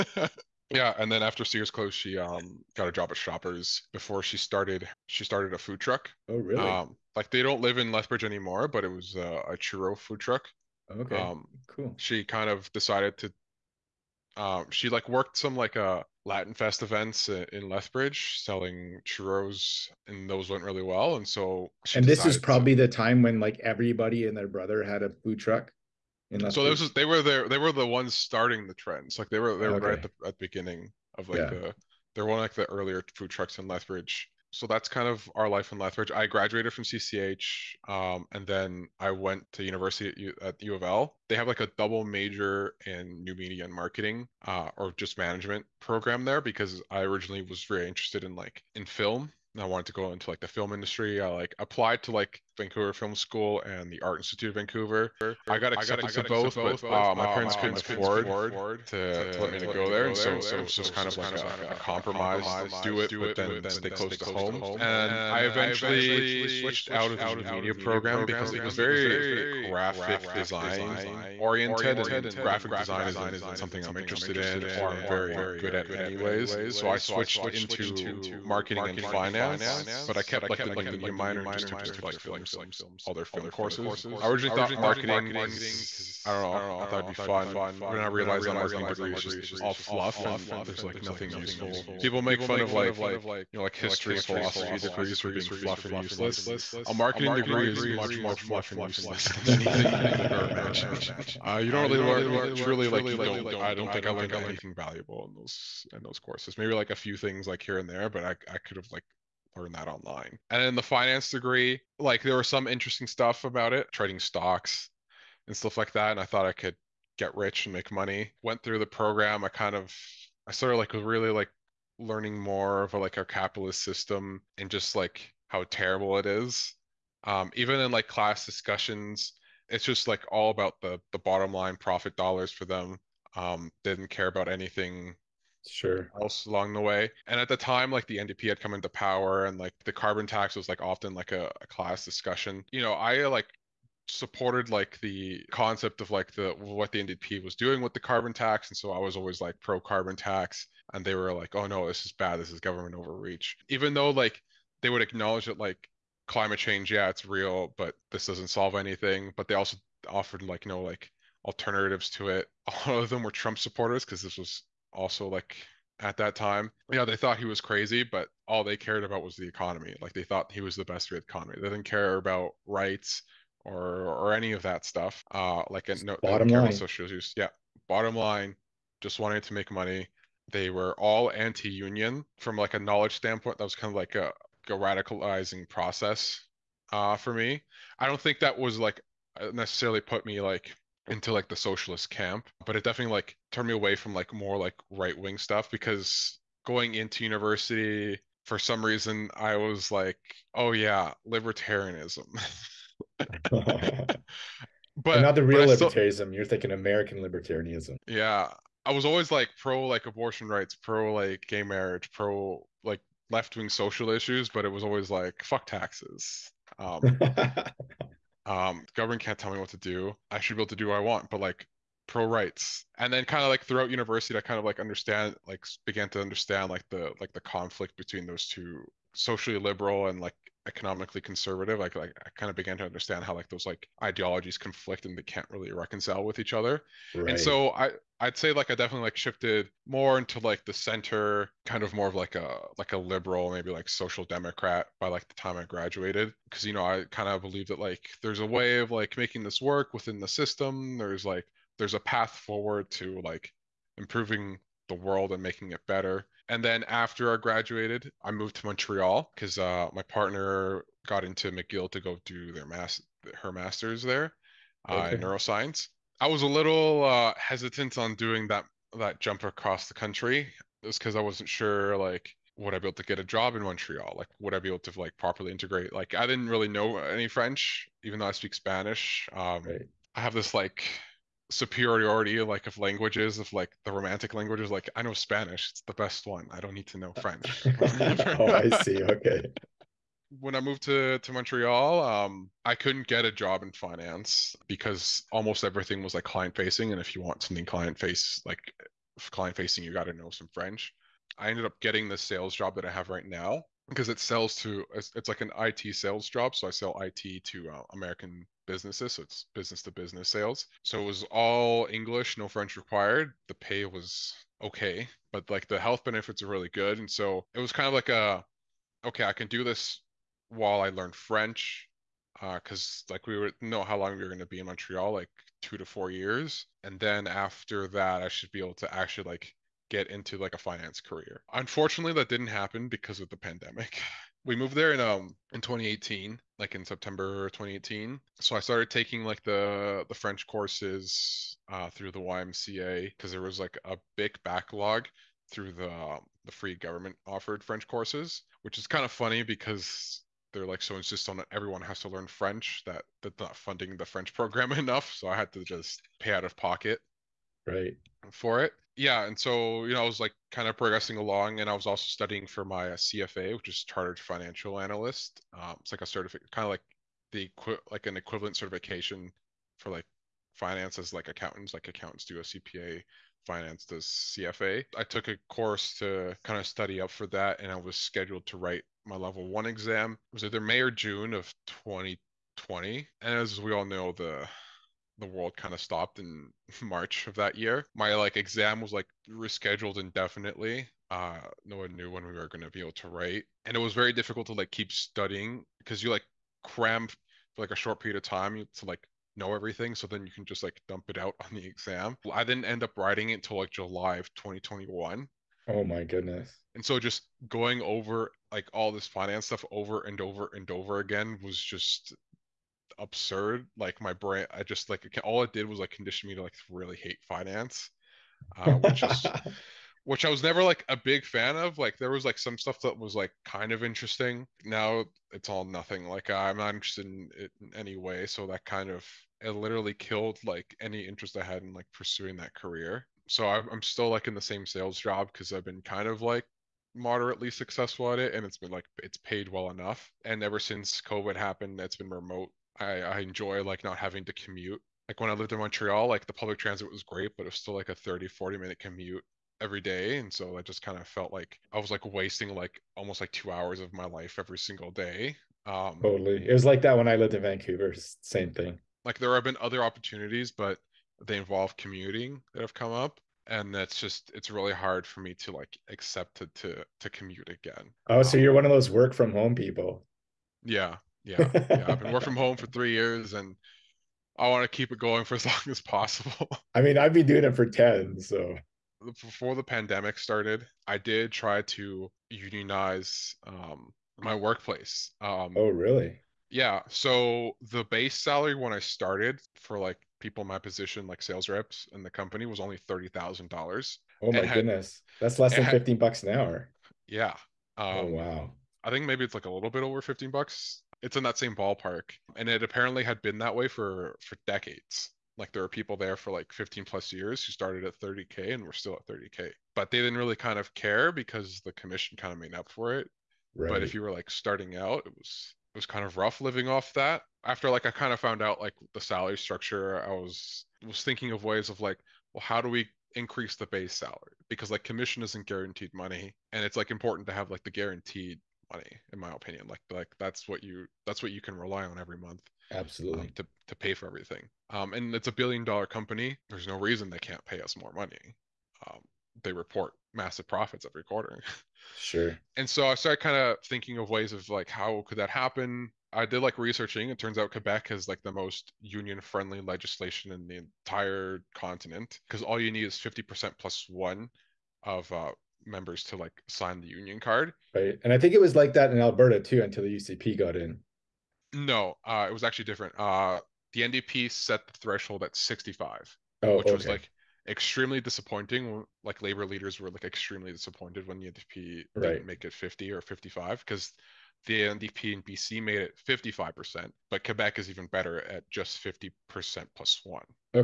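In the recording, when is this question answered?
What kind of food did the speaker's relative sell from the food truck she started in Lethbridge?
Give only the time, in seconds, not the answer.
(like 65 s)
9 s.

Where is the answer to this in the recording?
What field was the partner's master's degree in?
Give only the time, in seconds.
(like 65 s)
265 s.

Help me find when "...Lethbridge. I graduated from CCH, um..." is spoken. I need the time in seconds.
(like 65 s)
35 s.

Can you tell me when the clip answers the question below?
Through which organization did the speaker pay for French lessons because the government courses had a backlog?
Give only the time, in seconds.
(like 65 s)
342 s.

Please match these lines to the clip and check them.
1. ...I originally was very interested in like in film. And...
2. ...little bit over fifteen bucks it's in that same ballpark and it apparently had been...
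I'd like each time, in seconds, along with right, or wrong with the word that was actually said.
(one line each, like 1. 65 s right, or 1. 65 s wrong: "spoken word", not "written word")
1. 46 s right
2. 499 s right.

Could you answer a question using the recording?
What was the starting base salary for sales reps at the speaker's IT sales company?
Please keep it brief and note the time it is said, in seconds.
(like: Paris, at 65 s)
$30,000, at 492 s.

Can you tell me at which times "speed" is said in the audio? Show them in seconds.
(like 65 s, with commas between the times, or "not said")
not said.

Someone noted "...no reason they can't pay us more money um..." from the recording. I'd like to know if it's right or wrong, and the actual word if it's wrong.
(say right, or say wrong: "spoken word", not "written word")
right.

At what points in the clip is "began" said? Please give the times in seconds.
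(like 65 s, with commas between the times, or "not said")
225 s, 232 s.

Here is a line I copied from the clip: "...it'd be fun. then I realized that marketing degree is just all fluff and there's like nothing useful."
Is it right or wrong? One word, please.
right.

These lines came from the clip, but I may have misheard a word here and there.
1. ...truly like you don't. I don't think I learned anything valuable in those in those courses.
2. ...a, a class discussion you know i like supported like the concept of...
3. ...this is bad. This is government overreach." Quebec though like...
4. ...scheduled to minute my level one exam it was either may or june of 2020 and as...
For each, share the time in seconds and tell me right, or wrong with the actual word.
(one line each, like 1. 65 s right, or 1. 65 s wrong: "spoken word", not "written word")
1. 102 s right
2. 141 s right
3. 151 s wrong: "Even", not "Quebec"
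4. 377 s wrong: "write", not "minute".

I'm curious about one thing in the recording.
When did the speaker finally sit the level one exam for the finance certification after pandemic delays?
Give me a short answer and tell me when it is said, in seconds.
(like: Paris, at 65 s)
July 2021, at 403 s.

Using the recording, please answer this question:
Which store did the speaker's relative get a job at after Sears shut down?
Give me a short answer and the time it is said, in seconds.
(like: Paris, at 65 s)
Shoppers, at 3 s.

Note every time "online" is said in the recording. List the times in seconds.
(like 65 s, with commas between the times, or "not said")
109 s.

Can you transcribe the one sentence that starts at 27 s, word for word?
They were the ones starting the trends.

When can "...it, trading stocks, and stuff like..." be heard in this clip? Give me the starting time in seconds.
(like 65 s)
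113 s.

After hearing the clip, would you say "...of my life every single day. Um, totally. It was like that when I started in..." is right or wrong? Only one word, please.
wrong.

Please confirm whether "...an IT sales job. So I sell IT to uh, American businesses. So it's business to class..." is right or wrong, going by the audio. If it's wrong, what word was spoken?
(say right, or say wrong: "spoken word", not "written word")
wrong: "business", not "class".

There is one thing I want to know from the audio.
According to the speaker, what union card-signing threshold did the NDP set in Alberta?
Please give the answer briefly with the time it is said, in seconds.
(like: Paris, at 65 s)
65%, at 565 s.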